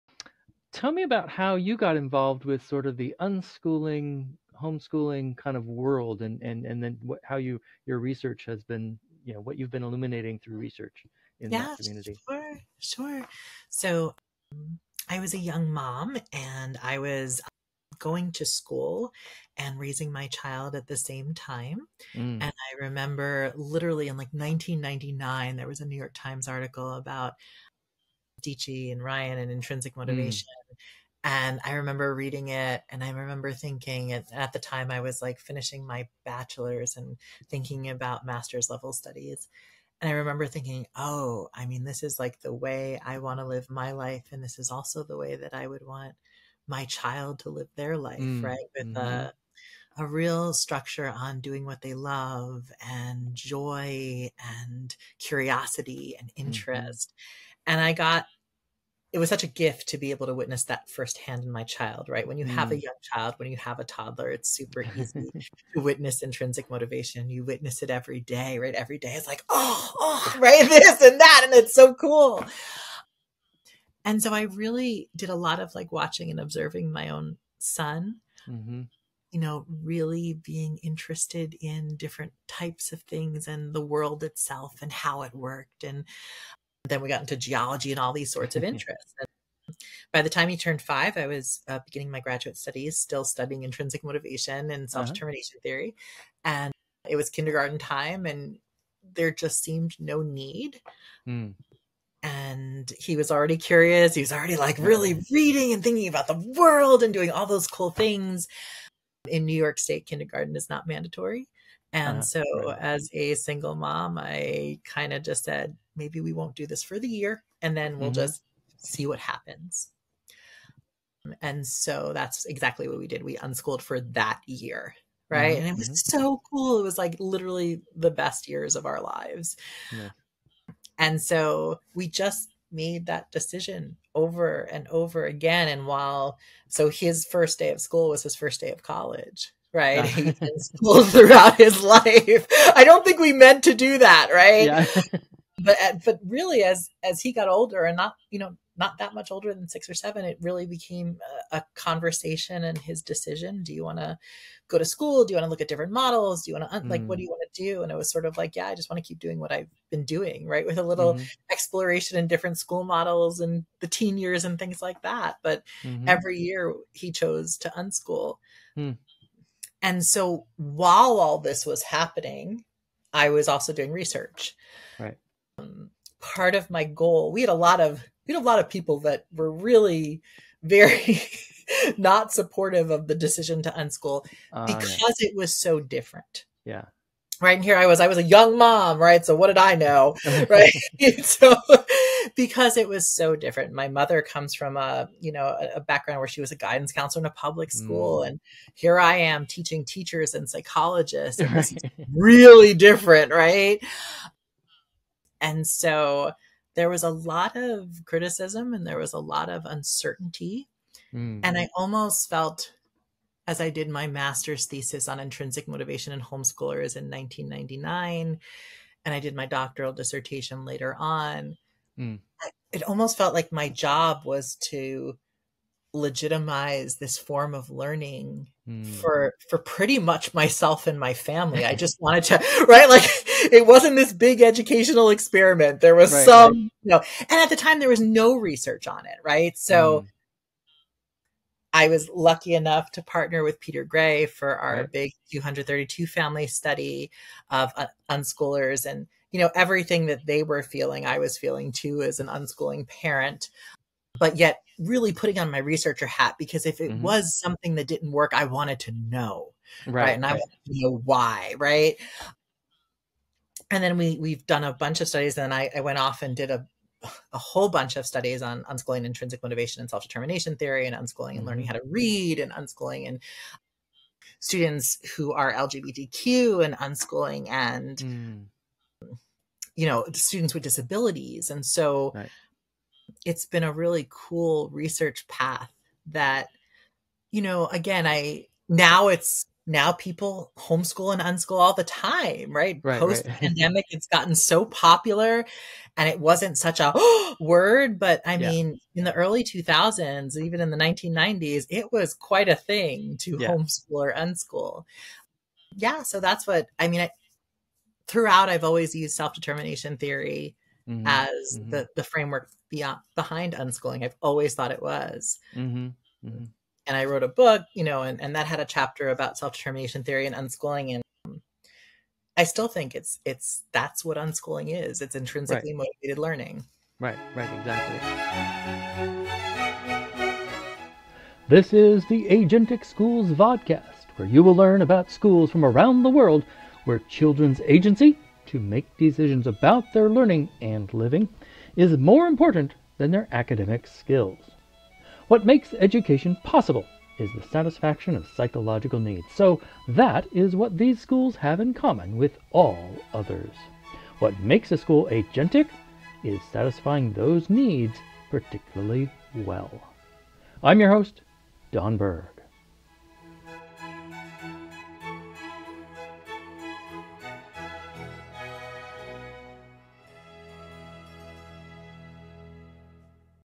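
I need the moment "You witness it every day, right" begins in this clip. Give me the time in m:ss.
1:07.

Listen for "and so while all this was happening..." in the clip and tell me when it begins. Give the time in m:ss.
2:49.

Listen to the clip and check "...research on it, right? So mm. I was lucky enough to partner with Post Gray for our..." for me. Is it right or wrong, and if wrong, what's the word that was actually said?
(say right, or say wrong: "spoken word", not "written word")
wrong: "Peter", not "Post".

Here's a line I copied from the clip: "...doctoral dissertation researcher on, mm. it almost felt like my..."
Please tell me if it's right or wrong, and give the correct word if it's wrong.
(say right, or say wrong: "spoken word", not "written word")
wrong: "later", not "researcher".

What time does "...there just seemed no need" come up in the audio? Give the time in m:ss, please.
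1:39.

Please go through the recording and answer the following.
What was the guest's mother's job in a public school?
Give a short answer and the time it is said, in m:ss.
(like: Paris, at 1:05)
Guidance counselor, at 3:16.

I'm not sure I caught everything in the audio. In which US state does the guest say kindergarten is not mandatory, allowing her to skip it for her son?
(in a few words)
New York State.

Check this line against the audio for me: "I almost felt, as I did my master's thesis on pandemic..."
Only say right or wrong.
wrong.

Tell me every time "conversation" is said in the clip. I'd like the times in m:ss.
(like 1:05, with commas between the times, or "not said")
2:31.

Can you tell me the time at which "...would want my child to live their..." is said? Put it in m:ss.
0:45.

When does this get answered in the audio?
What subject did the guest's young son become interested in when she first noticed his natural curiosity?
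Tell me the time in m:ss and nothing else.
1:27.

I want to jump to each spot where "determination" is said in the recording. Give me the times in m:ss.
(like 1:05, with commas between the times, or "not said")
1:35, 4:29, 5:09, 5:19.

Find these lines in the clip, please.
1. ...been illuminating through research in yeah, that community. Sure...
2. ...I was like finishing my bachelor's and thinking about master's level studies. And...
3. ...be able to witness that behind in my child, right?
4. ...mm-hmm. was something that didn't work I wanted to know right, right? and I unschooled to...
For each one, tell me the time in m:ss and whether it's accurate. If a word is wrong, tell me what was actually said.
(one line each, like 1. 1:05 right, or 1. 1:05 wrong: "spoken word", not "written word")
1. 0:09 right
2. 0:34 right
3. 0:59 wrong: "firsthand", not "behind"
4. 4:16 wrong: "wanted", not "unschooled".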